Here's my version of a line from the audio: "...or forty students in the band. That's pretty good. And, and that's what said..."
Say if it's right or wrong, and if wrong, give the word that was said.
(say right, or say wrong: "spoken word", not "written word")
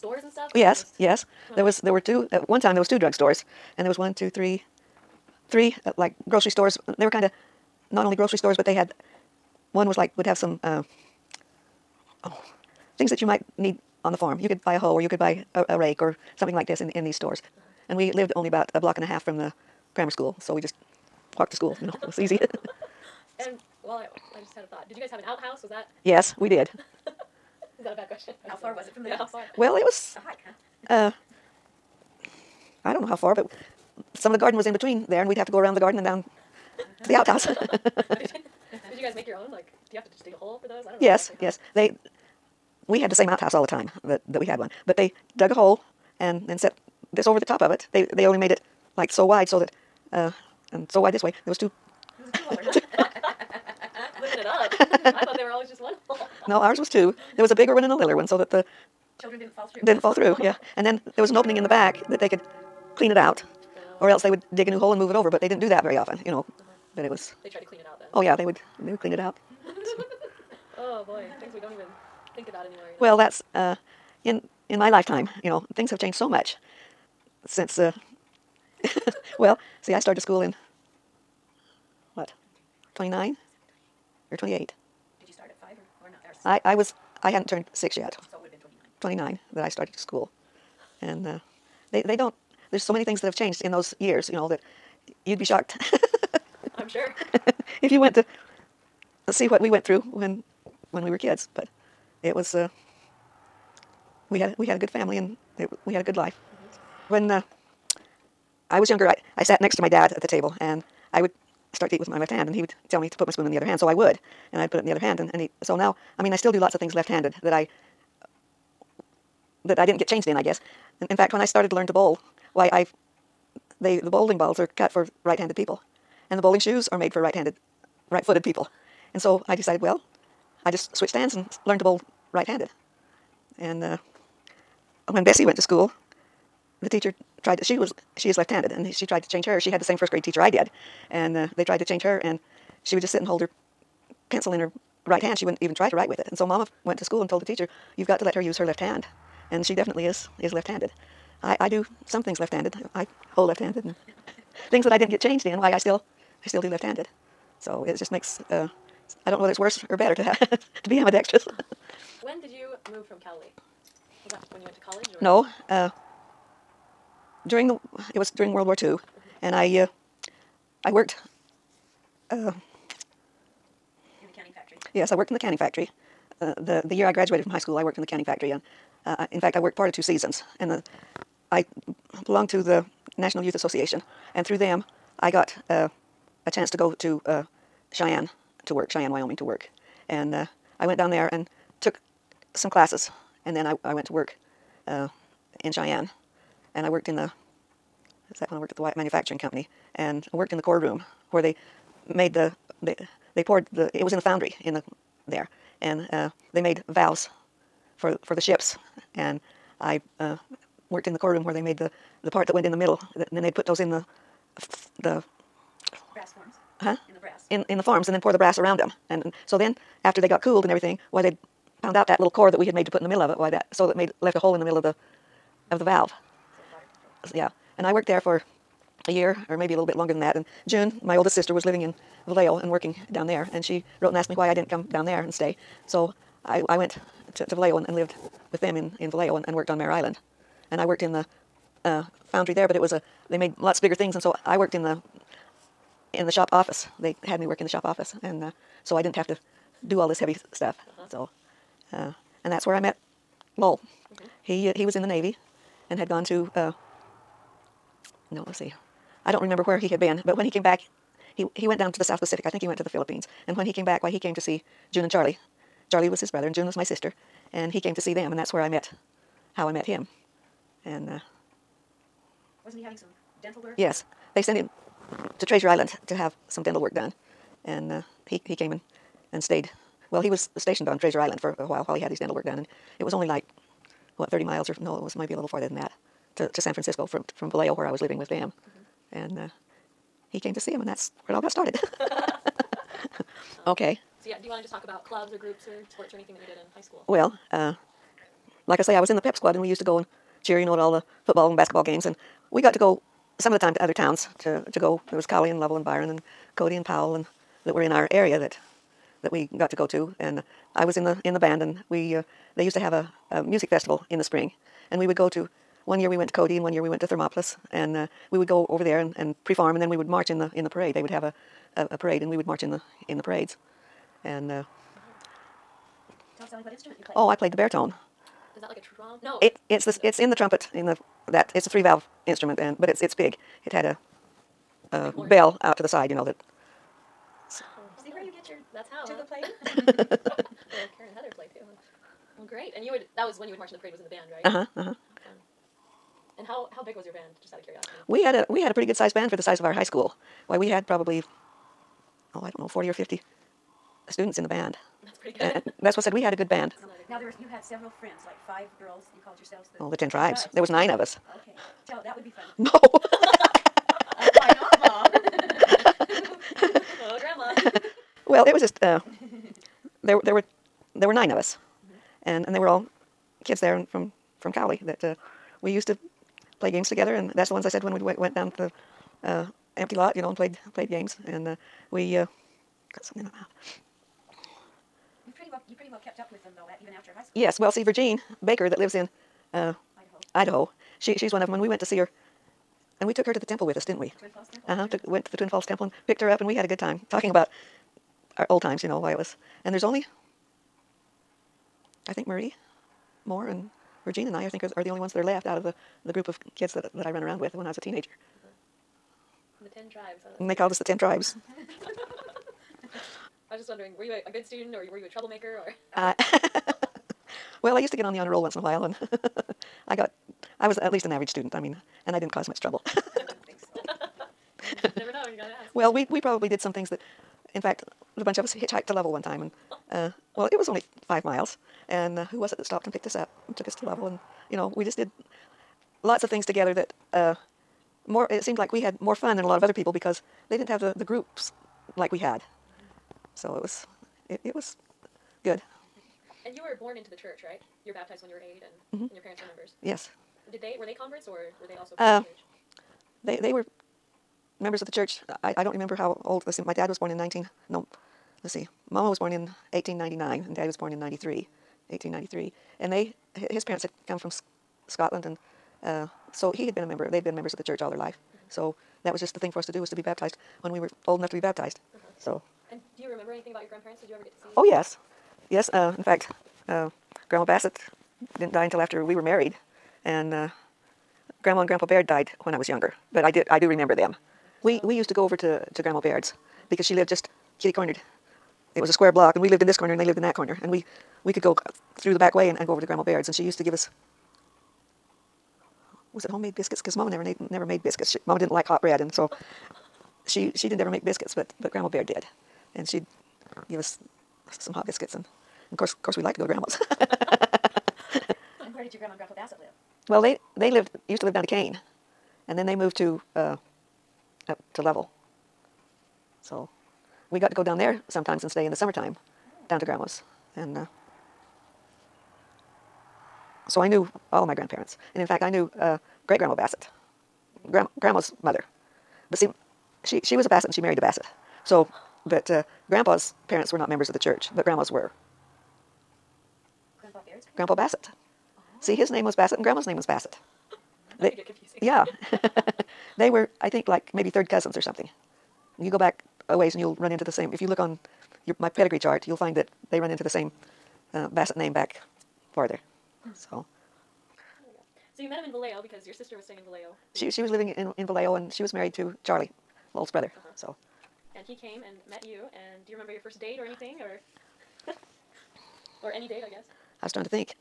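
wrong: "fifty", not "forty".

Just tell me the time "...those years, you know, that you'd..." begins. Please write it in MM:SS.
01:33.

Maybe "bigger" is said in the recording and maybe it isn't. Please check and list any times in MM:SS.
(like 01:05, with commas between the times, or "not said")
00:57, 04:03.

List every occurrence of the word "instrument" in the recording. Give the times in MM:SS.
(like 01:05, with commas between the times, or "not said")
05:26, 05:32.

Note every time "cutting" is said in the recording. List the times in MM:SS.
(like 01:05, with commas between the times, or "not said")
not said.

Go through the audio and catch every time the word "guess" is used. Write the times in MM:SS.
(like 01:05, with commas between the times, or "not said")
02:00, 09:26.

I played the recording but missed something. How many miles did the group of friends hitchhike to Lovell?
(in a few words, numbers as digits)
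5.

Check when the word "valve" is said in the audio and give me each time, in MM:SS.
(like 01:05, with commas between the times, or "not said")
03:26, 03:45, 05:31.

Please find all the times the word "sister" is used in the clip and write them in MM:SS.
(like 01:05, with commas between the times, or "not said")
03:51, 04:26, 09:16.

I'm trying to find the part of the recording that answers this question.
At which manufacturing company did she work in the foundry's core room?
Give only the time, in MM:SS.
03:18.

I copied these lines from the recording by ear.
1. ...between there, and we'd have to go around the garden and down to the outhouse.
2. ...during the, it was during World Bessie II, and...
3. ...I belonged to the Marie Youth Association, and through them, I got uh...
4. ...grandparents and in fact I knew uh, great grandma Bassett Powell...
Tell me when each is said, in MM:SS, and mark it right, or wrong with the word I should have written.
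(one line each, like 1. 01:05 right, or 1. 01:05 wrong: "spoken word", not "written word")
1. 00:34 right
2. 02:47 wrong: "War", not "Bessie"
3. 03:01 wrong: "National", not "Marie"
4. 08:44 wrong: "Grand", not "Powell".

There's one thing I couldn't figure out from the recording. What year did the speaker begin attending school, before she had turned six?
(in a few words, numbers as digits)
1929.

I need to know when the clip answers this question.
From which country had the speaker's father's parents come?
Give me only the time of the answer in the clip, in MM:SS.
07:44.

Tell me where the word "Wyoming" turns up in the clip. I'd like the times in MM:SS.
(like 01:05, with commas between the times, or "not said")
03:09.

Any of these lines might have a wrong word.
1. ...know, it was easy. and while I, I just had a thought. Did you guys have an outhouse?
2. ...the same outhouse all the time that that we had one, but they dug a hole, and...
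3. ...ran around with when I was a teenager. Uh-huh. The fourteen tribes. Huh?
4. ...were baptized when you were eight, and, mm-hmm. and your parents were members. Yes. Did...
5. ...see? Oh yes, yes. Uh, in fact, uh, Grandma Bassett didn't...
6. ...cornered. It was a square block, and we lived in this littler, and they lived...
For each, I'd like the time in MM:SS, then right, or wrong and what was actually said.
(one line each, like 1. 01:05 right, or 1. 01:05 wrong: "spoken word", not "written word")
1. 00:21 right
2. 00:43 right
3. 06:47 wrong: "ten", not "fourteen"
4. 07:27 right
5. 07:54 right
6. 08:07 wrong: "corner", not "littler".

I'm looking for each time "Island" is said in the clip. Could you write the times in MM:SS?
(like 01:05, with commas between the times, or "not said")
03:59, 04:35, 04:41.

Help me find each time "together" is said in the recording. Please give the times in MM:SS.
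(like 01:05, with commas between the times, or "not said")
06:16, 07:16.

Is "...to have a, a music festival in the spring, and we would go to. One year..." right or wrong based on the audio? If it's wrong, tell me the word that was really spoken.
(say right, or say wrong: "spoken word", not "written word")
right.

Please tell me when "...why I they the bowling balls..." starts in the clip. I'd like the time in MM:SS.
02:02.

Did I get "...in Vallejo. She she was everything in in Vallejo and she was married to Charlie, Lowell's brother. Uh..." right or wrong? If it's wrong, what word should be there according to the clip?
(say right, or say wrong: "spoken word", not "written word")
wrong: "living", not "everything".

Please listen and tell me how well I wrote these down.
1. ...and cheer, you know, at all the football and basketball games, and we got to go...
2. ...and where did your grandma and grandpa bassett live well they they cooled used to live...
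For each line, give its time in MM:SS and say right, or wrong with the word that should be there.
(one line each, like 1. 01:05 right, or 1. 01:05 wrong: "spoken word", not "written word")
1. 04:59 right
2. 08:27 wrong: "lived", not "cooled".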